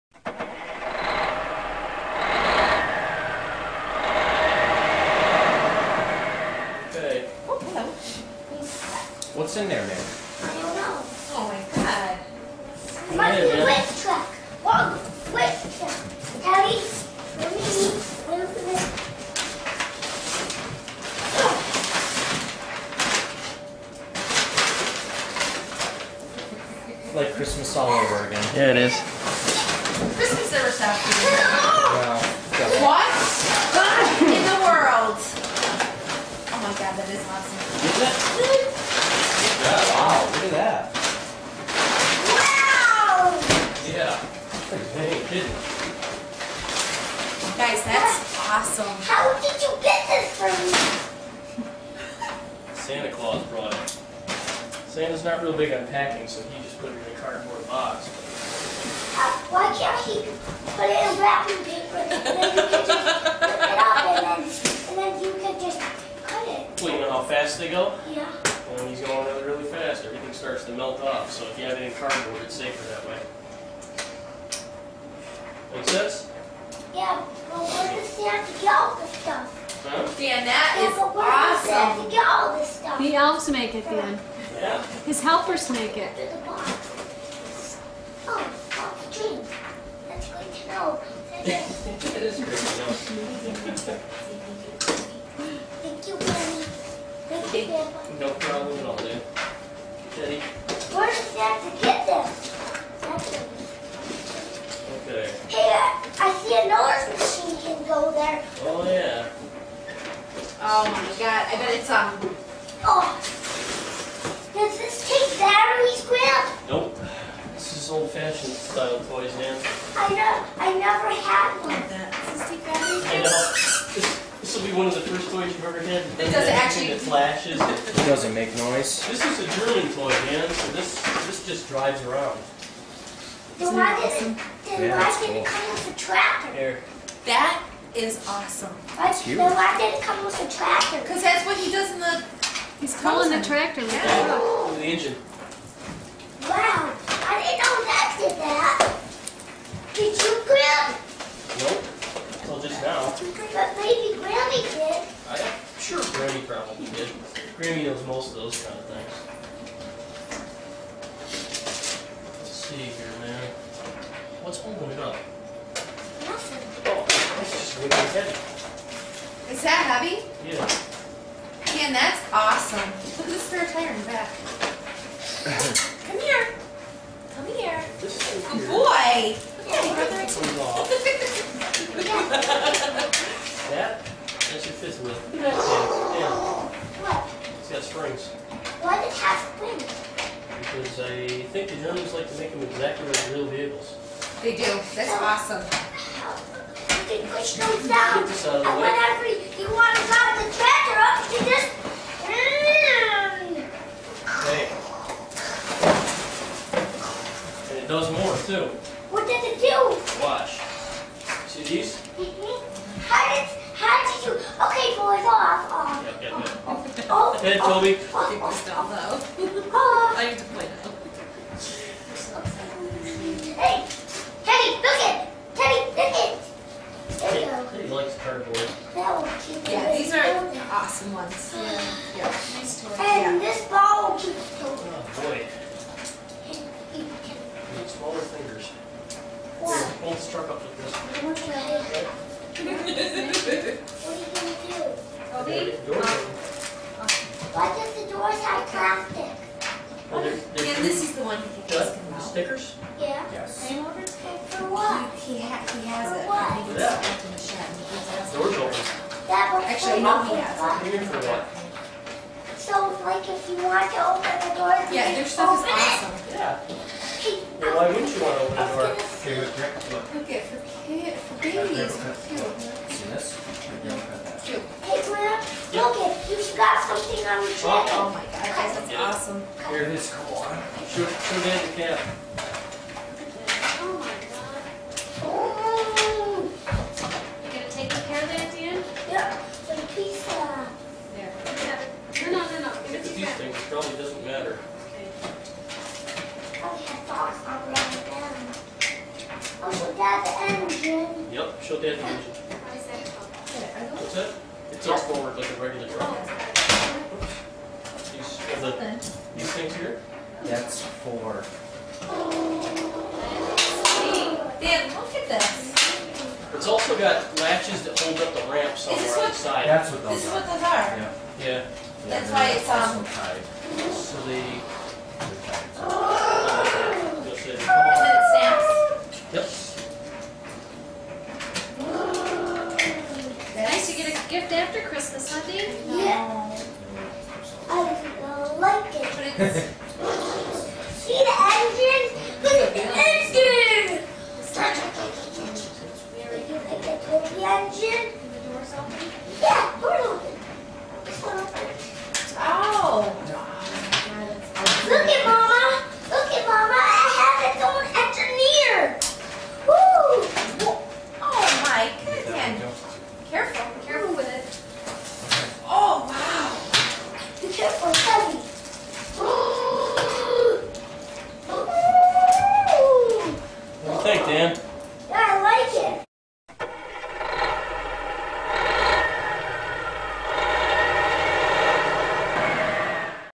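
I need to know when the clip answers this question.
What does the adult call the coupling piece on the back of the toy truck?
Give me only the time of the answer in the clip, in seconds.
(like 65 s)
184 s.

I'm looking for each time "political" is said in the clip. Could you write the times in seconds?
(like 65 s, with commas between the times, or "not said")
not said.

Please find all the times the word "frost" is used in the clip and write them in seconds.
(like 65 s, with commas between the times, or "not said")
not said.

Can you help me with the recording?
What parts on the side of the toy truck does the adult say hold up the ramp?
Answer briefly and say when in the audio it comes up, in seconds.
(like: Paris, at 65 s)
latches, at 317 s.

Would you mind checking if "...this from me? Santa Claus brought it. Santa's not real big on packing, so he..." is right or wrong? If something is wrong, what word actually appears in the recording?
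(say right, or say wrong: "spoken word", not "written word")
right.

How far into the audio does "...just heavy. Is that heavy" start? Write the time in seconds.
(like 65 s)
167 s.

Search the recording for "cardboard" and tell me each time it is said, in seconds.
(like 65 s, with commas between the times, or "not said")
57 s, 71 s, 228 s.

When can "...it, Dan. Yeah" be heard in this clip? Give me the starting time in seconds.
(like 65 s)
83 s.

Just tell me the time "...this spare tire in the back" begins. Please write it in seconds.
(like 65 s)
173 s.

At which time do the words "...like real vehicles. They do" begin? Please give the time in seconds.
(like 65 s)
193 s.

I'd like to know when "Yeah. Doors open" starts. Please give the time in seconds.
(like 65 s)
258 s.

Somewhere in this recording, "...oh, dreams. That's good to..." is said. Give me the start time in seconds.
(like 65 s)
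88 s.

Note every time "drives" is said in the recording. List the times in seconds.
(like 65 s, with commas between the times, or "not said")
131 s, 200 s.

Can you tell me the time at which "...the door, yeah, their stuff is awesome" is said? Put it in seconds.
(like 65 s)
264 s.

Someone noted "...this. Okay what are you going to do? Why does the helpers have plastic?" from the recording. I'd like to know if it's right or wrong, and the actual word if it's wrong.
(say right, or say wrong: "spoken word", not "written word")
wrong: "doors", not "helpers".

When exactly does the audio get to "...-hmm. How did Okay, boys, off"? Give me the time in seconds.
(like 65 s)
212 s.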